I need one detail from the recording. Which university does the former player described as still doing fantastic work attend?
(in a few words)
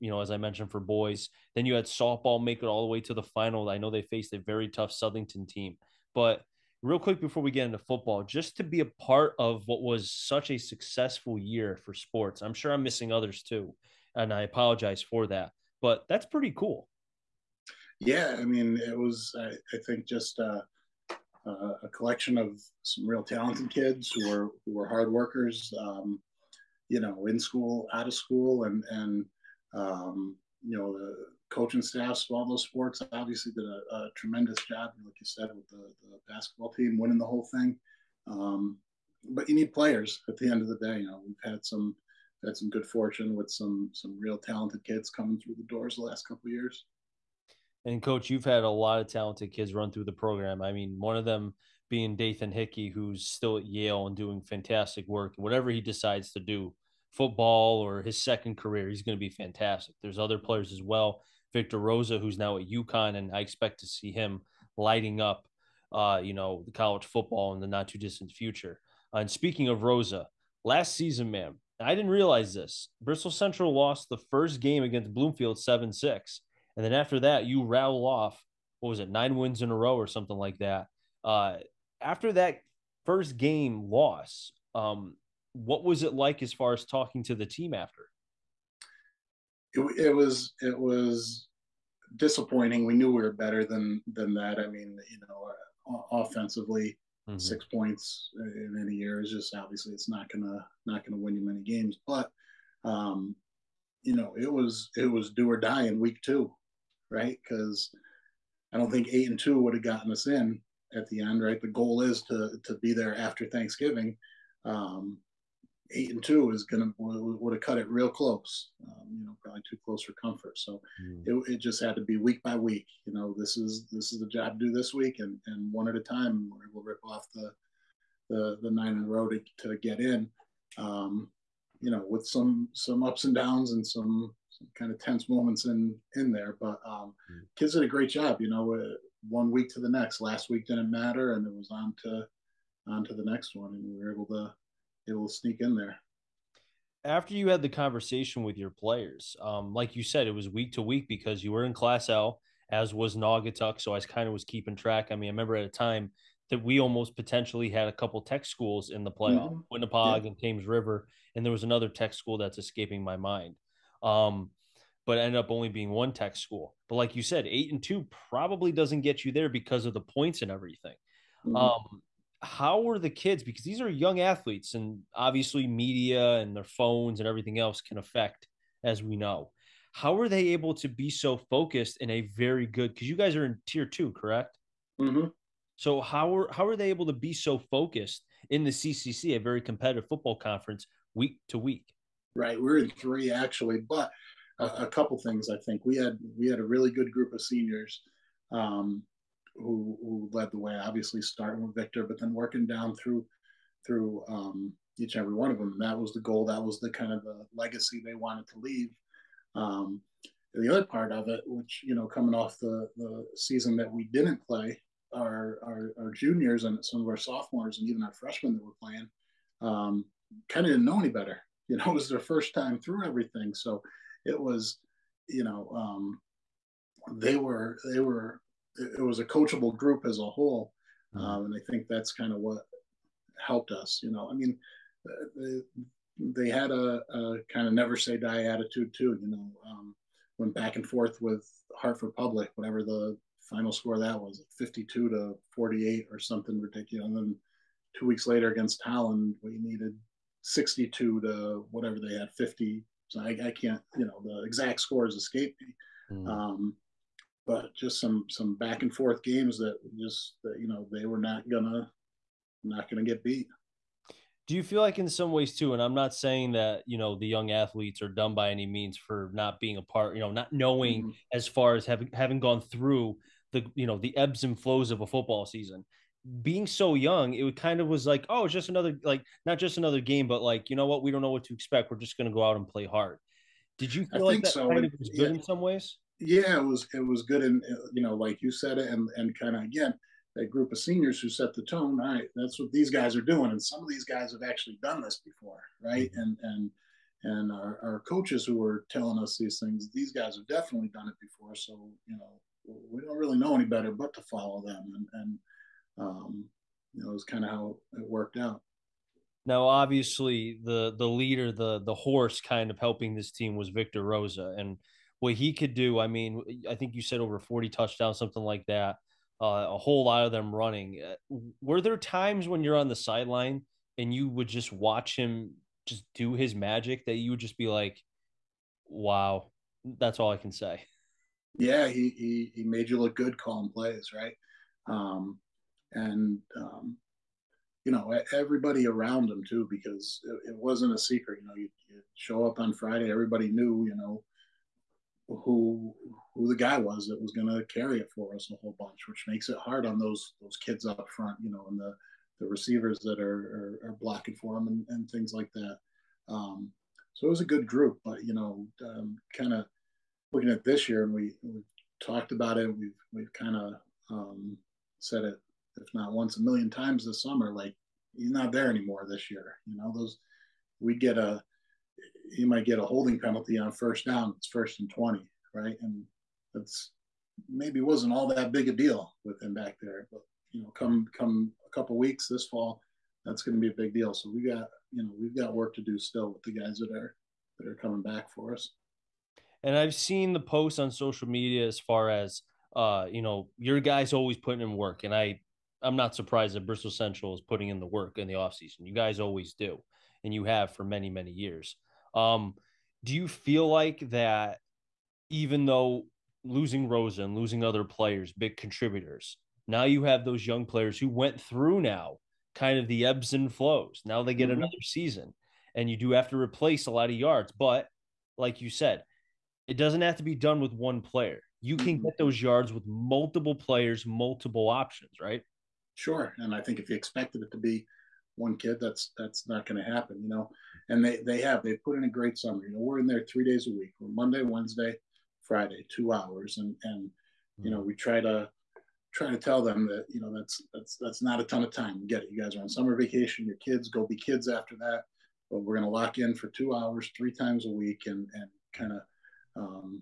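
Yale.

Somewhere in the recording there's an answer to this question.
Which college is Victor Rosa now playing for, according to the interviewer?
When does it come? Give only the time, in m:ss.
1:02.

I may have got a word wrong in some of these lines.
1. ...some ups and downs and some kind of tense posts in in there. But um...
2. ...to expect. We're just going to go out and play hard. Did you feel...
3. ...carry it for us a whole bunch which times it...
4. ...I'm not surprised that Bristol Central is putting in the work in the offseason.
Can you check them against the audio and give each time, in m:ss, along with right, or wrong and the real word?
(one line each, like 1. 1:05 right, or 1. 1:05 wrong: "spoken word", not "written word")
1. 2:12 wrong: "moments", not "posts"
2. 4:41 right
3. 5:47 wrong: "makes", not "times"
4. 6:35 right.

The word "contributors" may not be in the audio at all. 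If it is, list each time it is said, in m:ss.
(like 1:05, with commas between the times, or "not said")
6:48.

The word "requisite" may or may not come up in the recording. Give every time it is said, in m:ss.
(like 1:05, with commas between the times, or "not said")
not said.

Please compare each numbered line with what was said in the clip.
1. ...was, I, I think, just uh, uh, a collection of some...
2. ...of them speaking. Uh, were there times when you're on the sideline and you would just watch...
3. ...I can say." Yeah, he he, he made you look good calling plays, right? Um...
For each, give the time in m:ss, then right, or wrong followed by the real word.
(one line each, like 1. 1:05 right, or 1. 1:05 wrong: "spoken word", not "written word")
1. 0:18 right
2. 5:20 wrong: "running", not "speaking"
3. 5:30 right.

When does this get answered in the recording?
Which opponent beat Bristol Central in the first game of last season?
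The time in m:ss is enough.
1:15.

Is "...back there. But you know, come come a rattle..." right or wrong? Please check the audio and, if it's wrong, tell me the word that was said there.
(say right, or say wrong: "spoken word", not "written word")
wrong: "couple", not "rattle".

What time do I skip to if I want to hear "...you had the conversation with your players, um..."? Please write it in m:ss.
2:27.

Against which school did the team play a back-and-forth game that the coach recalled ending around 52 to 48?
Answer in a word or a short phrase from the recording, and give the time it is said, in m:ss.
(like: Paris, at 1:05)
Hartford Public, at 4:01.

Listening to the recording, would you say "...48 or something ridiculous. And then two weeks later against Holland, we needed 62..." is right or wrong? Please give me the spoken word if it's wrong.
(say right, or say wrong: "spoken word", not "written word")
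right.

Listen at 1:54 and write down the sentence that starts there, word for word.
Um, eight and two is gonna would have cut it real close, um, you know, probably too close for comfort.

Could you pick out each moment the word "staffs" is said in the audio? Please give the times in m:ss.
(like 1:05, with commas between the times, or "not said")
0:31.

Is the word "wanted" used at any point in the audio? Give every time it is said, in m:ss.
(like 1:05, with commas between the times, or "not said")
3:28.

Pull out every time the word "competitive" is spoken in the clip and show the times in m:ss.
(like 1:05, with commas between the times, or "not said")
3:09.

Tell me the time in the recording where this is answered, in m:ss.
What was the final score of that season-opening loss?
1:15.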